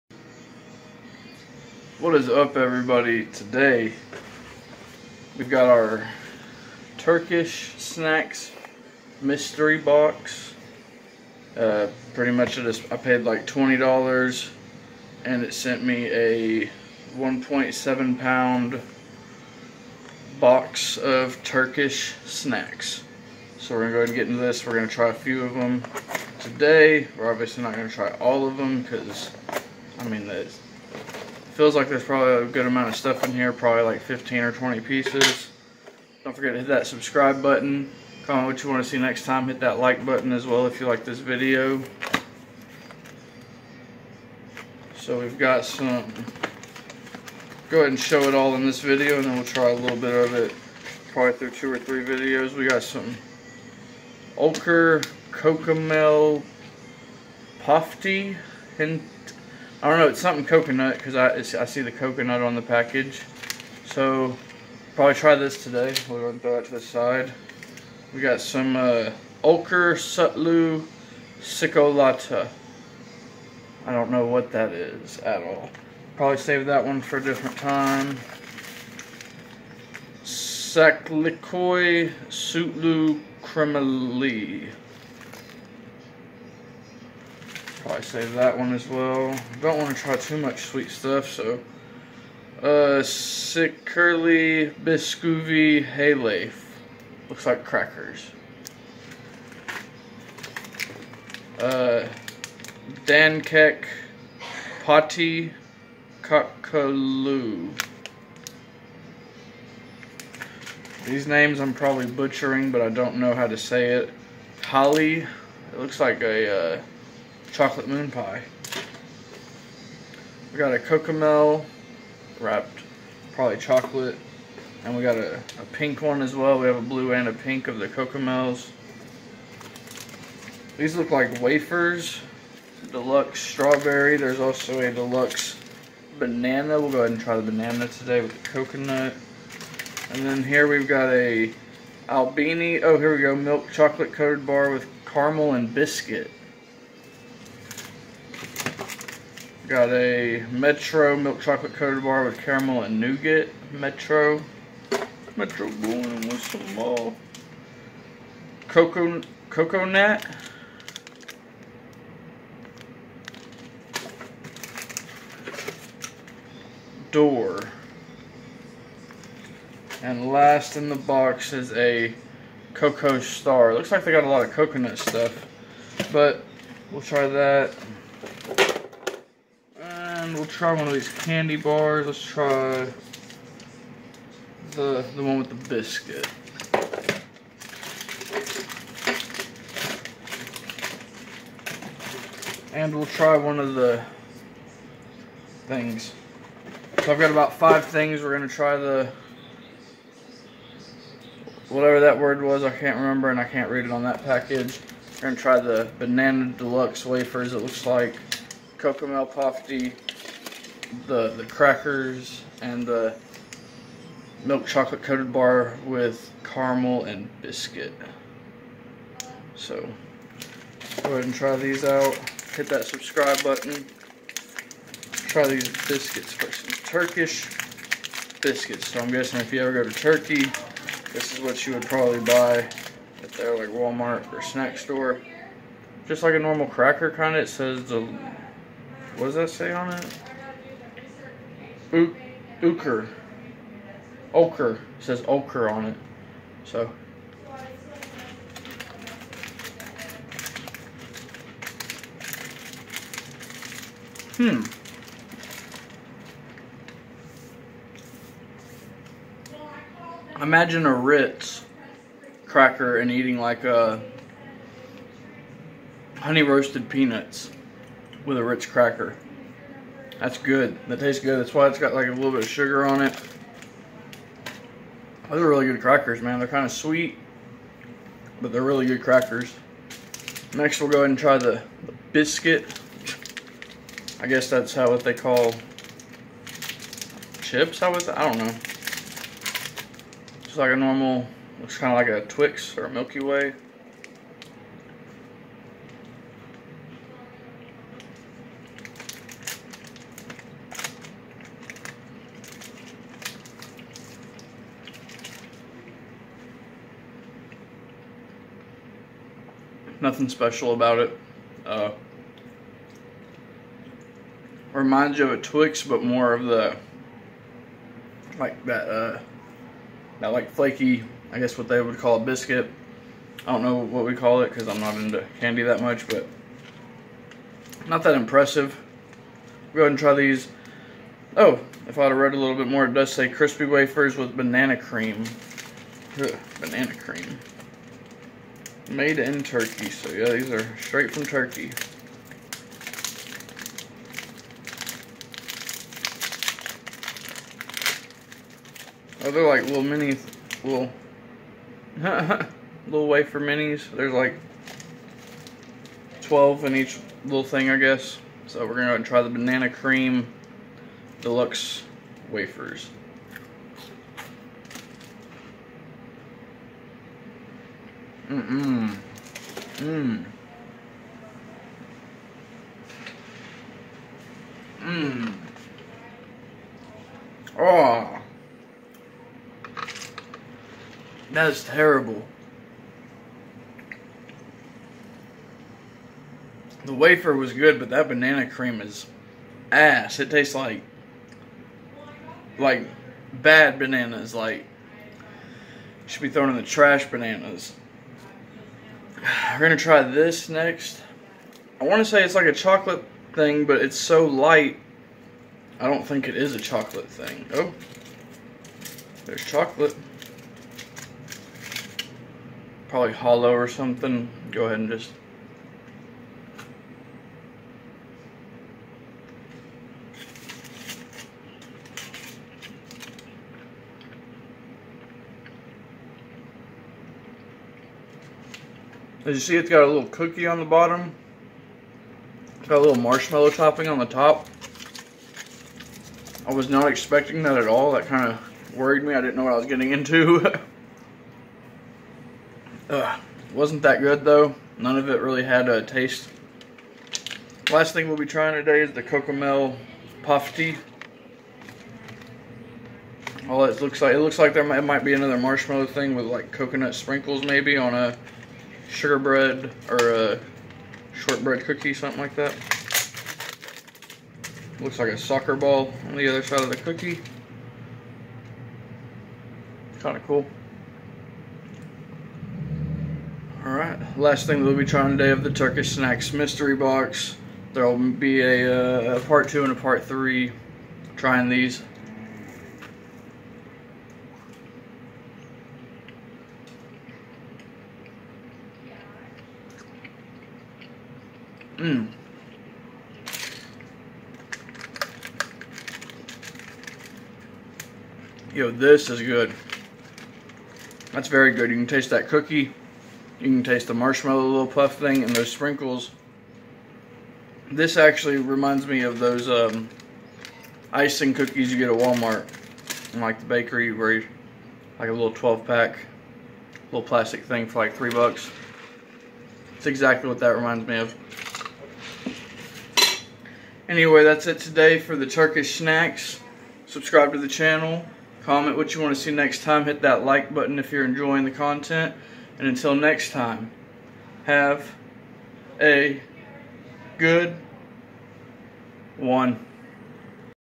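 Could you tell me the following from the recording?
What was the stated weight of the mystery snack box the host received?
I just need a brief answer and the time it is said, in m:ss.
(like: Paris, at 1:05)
1.7 pounds, at 0:17.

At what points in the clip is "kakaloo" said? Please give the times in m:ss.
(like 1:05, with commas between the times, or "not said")
1:46.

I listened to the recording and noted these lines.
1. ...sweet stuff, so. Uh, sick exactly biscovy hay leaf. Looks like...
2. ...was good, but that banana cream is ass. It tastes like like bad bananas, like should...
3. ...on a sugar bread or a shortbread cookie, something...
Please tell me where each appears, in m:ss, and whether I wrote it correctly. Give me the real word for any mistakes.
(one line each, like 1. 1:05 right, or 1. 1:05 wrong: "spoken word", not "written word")
1. 1:30 wrong: "curly", not "exactly"
2. 6:27 right
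3. 7:37 right.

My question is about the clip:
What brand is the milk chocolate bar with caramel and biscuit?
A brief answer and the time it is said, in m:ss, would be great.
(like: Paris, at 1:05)
Albeni, at 2:22.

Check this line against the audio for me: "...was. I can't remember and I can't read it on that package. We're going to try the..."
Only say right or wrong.
right.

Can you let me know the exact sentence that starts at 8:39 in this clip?
It's exactly what that reminds me of.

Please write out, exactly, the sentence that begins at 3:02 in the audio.
Let's try the, the one with the biscuit.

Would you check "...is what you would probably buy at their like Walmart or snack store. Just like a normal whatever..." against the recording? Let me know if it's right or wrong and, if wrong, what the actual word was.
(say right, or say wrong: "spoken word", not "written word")
wrong: "cracker", not "whatever".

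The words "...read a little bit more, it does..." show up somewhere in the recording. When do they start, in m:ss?
5:32.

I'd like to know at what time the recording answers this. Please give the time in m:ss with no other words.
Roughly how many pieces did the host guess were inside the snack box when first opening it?
0:34.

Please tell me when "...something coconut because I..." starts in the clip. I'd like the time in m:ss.
1:00.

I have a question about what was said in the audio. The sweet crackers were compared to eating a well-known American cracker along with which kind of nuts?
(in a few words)
Honey roasted peanuts.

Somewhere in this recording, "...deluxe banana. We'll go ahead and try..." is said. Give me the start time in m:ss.
2:14.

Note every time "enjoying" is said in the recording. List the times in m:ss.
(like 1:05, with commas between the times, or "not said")
8:51.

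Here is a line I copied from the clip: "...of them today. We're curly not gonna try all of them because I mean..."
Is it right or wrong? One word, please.
wrong.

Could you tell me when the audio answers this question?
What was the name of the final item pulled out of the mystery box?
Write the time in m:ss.
2:52.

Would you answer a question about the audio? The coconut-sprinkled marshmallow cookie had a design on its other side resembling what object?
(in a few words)
A soccer ball.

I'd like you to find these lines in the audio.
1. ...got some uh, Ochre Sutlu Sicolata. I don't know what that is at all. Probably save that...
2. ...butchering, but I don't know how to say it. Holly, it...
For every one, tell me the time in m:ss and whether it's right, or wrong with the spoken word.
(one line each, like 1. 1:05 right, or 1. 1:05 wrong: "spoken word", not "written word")
1. 1:08 right
2. 1:52 right.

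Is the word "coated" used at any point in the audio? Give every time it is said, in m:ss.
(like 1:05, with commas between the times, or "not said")
2:24, 2:31, 3:35.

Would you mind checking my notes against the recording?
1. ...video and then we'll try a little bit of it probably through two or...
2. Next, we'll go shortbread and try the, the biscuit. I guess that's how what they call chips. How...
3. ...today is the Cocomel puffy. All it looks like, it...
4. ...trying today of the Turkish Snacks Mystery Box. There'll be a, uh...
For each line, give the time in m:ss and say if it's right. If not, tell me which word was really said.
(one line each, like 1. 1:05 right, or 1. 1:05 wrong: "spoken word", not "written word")
1. 0:48 right
2. 4:40 wrong: "ahead", not "shortbread"
3. 7:28 right
4. 7:54 right.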